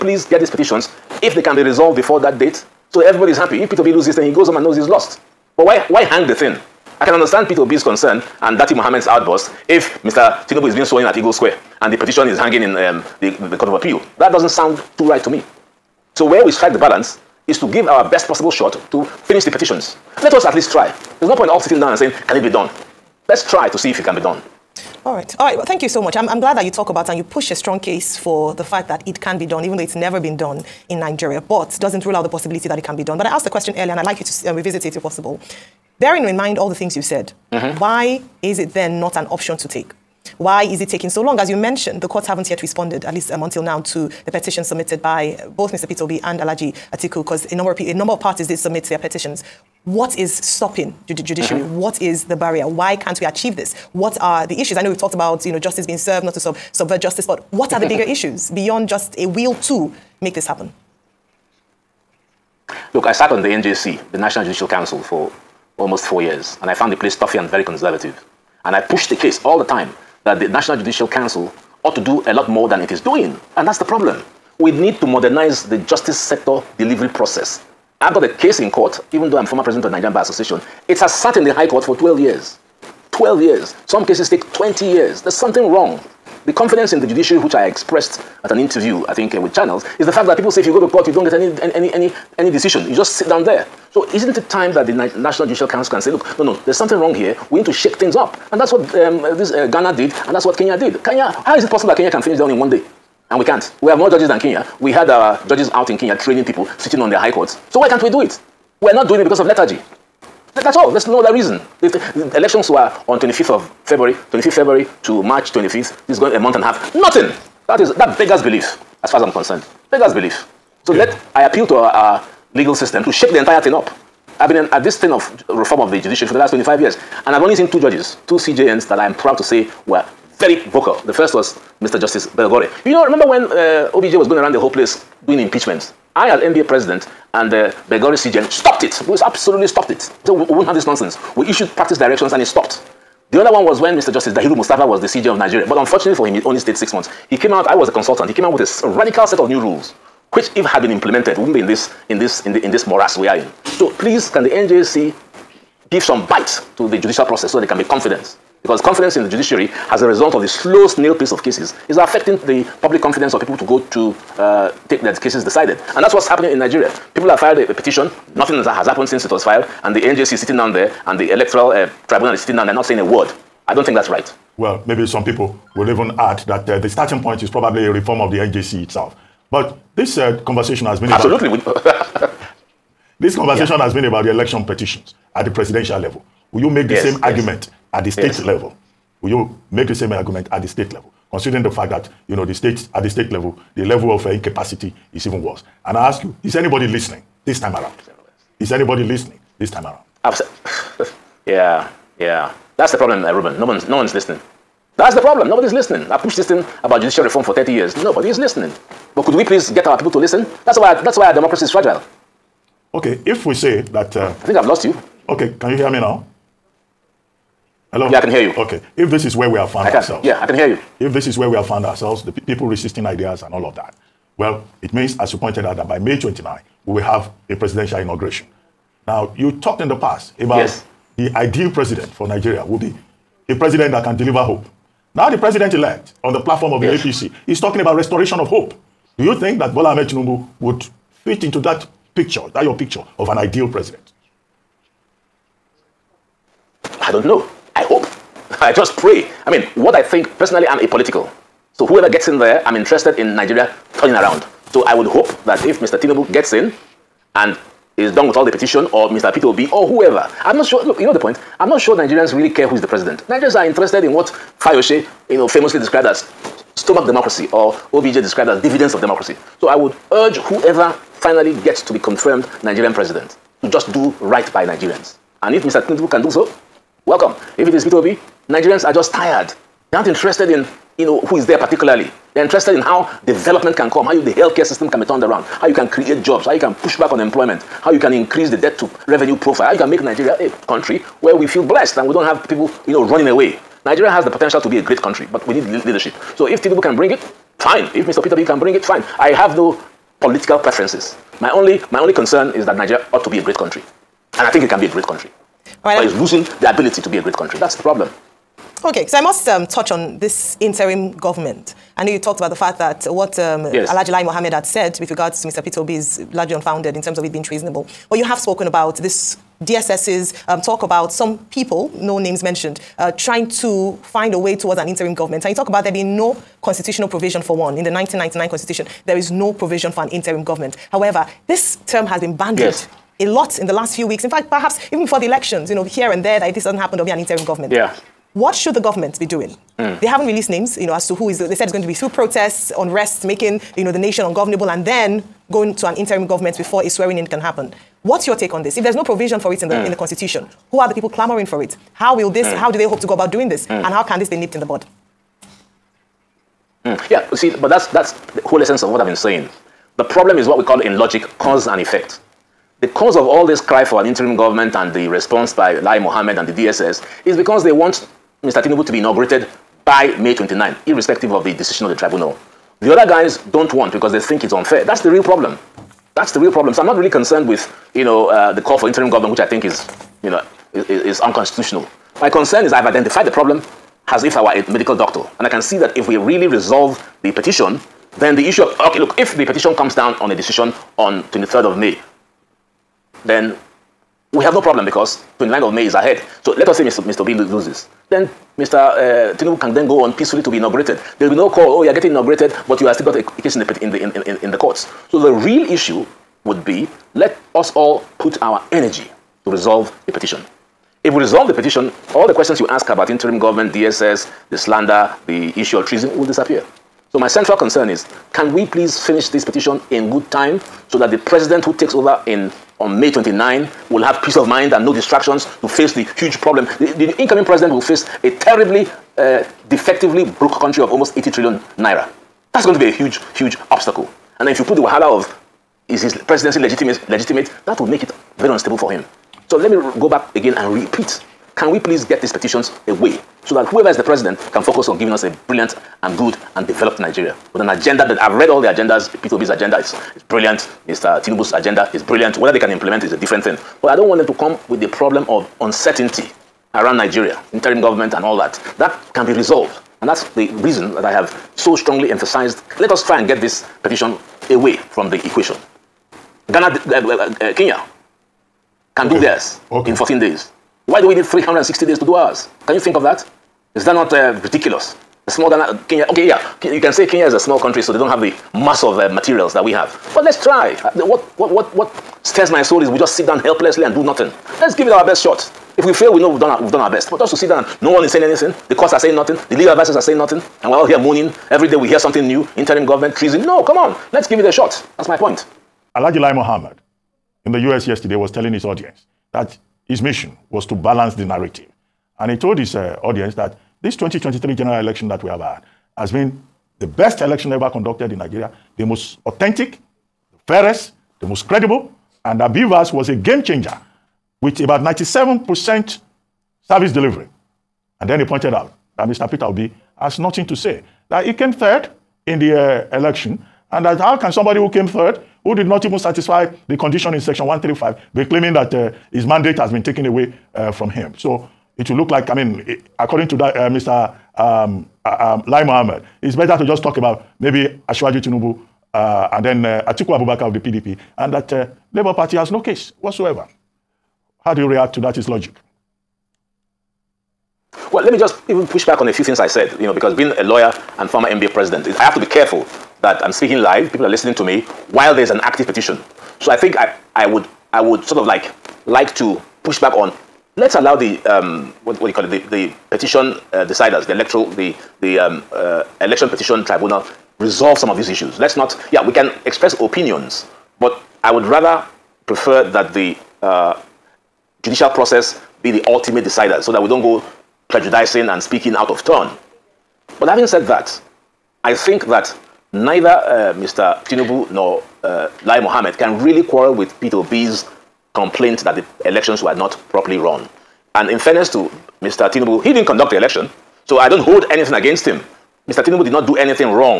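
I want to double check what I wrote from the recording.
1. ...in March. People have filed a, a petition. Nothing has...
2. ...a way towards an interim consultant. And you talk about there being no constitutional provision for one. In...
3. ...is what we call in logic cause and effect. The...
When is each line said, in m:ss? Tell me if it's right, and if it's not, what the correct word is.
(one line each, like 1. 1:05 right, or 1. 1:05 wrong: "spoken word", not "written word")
1. 2:46 wrong: "Nigeria", not "March"
2. 5:24 wrong: "government", not "consultant"
3. 6:00 right.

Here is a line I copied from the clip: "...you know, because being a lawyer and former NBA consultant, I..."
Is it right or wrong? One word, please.
wrong.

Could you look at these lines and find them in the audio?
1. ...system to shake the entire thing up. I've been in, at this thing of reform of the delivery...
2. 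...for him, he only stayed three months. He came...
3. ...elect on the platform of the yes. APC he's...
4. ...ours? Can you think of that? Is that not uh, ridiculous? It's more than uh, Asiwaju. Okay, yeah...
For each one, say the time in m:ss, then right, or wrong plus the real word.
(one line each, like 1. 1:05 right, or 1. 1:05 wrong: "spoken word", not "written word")
1. 2:02 wrong: "judiciary", not "delivery"
2. 2:26 wrong: "six", not "three"
3. 3:55 right
4. 7:52 wrong: "Kenya", not "Asiwaju".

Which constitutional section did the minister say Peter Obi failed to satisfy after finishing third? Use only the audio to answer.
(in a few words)
section 135.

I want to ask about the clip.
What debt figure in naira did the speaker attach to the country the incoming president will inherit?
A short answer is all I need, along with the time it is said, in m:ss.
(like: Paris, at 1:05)
almost 80 trillion naira, at 7:10.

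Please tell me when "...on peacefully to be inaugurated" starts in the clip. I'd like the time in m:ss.
6:40.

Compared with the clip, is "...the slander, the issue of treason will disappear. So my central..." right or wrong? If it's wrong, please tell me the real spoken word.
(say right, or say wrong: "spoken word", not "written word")
right.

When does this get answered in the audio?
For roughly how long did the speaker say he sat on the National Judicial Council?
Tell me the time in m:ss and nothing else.
1:05.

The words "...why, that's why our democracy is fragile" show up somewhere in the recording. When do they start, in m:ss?
3:30.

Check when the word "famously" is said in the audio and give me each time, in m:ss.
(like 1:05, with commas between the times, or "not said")
4:25.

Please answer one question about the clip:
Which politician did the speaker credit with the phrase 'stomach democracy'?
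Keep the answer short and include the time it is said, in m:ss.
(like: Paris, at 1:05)
Fayose, at 4:24.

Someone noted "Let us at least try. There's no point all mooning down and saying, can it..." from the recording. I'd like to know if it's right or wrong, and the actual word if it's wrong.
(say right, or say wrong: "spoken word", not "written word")
wrong: "sitting", not "mooning".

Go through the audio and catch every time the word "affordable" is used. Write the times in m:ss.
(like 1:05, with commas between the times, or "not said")
not said.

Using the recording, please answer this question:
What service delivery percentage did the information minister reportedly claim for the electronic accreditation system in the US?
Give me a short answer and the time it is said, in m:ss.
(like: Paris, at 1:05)
97%, at 8:34.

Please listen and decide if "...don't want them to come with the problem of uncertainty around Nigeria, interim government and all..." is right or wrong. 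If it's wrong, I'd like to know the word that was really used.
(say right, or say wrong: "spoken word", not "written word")
right.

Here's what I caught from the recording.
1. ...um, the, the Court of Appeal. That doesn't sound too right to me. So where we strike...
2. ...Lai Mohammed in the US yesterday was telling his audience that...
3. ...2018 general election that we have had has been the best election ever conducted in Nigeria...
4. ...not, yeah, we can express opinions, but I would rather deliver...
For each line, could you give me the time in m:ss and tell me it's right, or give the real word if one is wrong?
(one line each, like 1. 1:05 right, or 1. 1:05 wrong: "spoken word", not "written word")
1. 0:12 right
2. 8:16 right
3. 8:23 wrong: "2023", not "2018"
4. 9:28 wrong: "prefer", not "deliver".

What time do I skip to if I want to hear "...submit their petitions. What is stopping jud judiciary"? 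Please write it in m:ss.
0:48.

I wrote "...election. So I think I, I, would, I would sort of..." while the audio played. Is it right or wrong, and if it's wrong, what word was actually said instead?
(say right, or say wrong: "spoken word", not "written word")
wrong: "petition", not "election".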